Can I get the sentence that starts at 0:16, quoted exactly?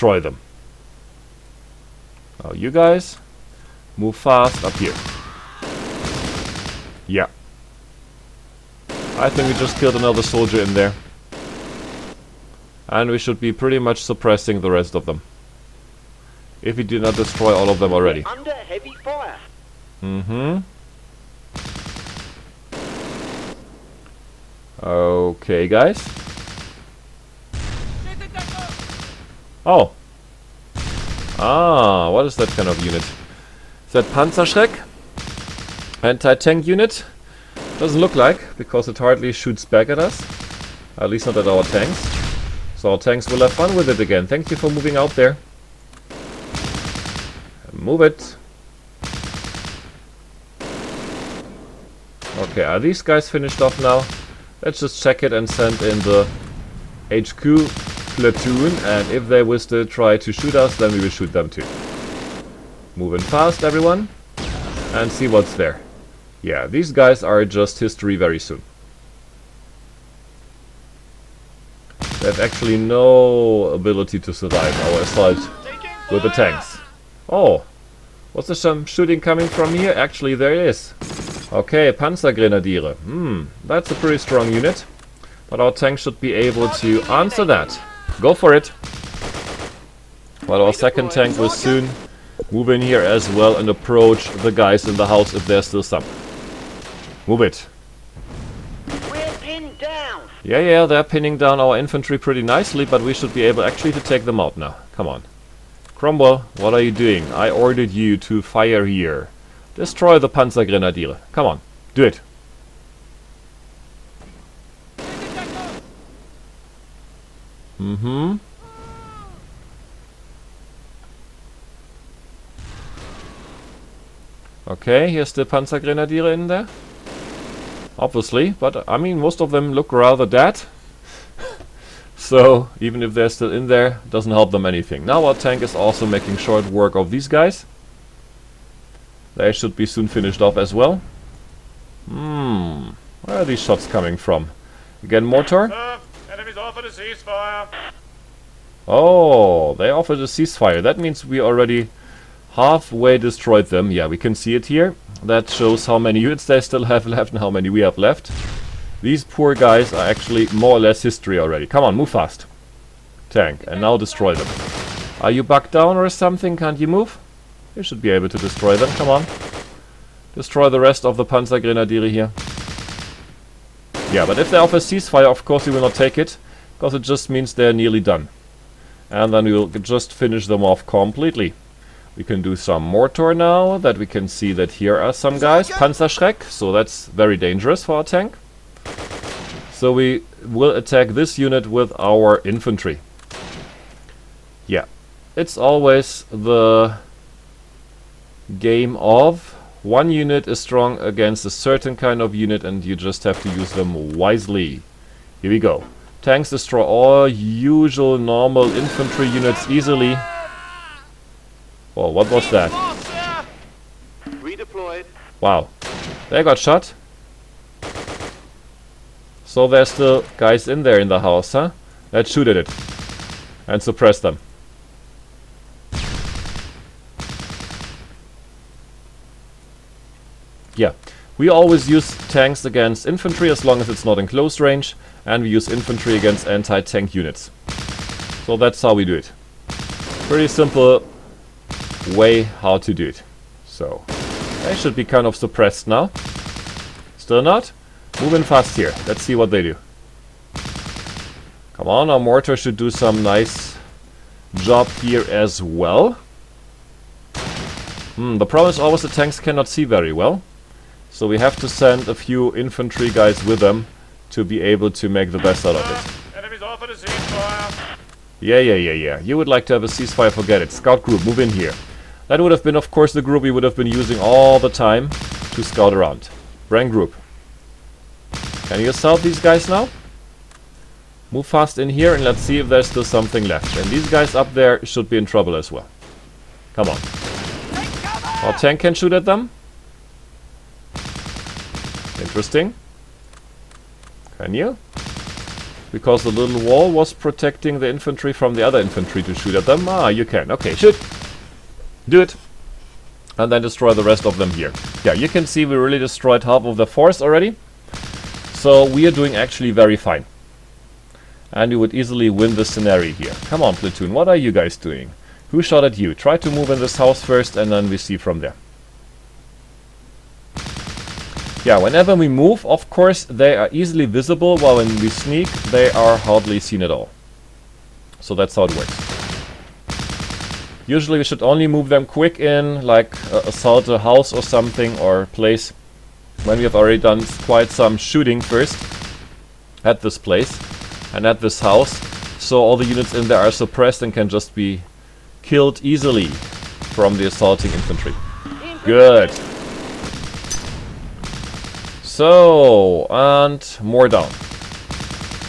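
If we do not destroy all of them already.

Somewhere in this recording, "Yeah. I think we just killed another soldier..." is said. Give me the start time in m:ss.
0:07.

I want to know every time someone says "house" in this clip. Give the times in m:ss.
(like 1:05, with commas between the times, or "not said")
1:35, 3:41, 5:16, 5:33, 5:41.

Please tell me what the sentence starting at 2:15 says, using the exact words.
Now our tank is also making short work of these guys.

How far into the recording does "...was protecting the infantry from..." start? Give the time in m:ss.
4:56.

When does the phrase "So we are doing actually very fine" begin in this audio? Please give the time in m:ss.
5:08.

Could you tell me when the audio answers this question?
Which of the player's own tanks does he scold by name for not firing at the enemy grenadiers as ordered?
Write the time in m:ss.
1:45.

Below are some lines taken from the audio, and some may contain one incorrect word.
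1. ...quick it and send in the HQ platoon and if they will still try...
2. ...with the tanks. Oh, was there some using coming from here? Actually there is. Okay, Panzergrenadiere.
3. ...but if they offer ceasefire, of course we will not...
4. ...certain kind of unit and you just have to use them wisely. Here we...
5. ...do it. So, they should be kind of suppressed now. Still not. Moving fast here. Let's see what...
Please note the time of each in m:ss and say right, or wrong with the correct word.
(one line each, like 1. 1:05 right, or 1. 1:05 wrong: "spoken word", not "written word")
1. 0:55 wrong: "check", not "quick"
2. 1:16 wrong: "shooting", not "using"
3. 2:54 right
4. 3:21 right
5. 4:02 right.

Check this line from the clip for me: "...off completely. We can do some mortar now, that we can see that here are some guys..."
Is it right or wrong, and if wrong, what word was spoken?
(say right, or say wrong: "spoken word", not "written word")
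right.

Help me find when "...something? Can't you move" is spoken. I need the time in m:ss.
2:46.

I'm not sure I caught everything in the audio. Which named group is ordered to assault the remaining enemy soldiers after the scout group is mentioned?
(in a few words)
Bren group.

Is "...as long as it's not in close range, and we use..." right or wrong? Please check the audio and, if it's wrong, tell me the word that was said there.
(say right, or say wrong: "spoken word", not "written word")
right.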